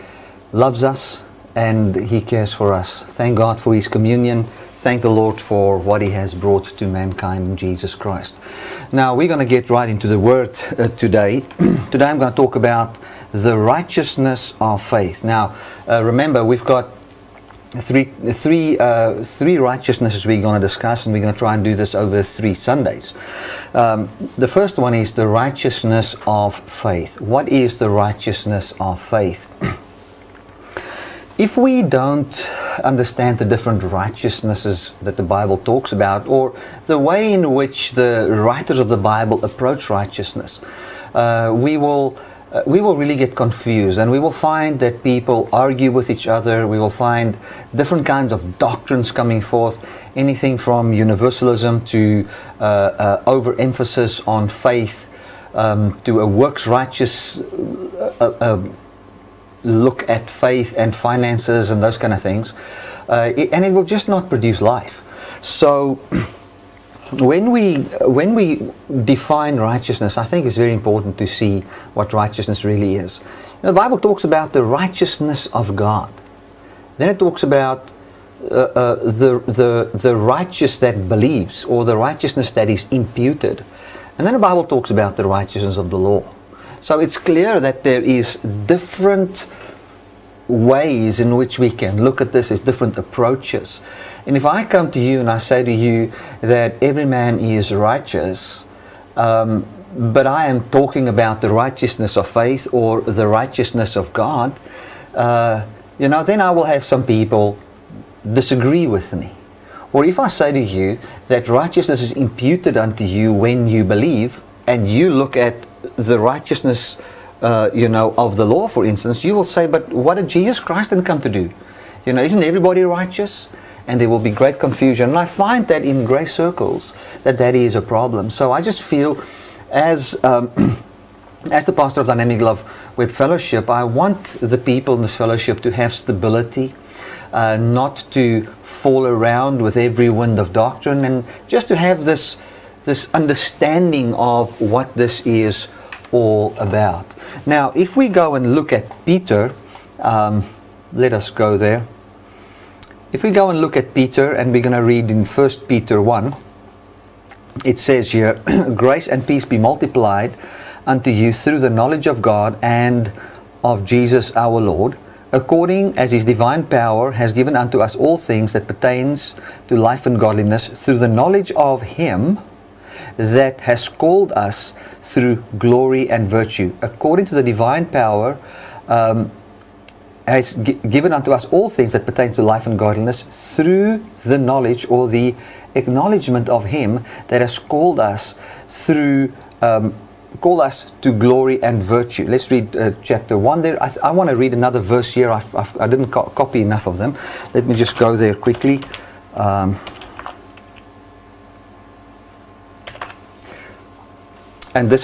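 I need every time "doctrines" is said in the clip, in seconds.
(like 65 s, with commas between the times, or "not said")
48 s, 140 s.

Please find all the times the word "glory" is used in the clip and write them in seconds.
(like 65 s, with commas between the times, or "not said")
175 s, 191 s.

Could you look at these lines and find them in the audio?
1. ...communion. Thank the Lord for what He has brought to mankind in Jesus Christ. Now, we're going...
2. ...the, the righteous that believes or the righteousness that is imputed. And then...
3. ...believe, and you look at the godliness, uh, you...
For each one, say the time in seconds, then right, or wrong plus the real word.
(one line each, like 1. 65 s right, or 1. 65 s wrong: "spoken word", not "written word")
1. 3 s right
2. 79 s right
3. 113 s wrong: "righteousness", not "godliness".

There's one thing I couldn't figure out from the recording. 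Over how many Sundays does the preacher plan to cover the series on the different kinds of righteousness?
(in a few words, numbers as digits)
3.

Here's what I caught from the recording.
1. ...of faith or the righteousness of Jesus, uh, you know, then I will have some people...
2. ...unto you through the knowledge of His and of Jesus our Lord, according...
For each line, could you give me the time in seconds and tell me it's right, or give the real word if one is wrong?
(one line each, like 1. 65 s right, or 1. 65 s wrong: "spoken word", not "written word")
1. 102 s wrong: "God", not "Jesus"
2. 160 s wrong: "God", not "His".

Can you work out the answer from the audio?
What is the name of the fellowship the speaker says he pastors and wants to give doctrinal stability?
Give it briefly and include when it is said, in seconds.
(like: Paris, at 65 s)
Dynamic Love Web Fellowship, at 132 s.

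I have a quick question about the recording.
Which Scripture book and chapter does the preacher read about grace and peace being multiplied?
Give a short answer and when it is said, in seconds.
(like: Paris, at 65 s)
1 Peter 1, at 155 s.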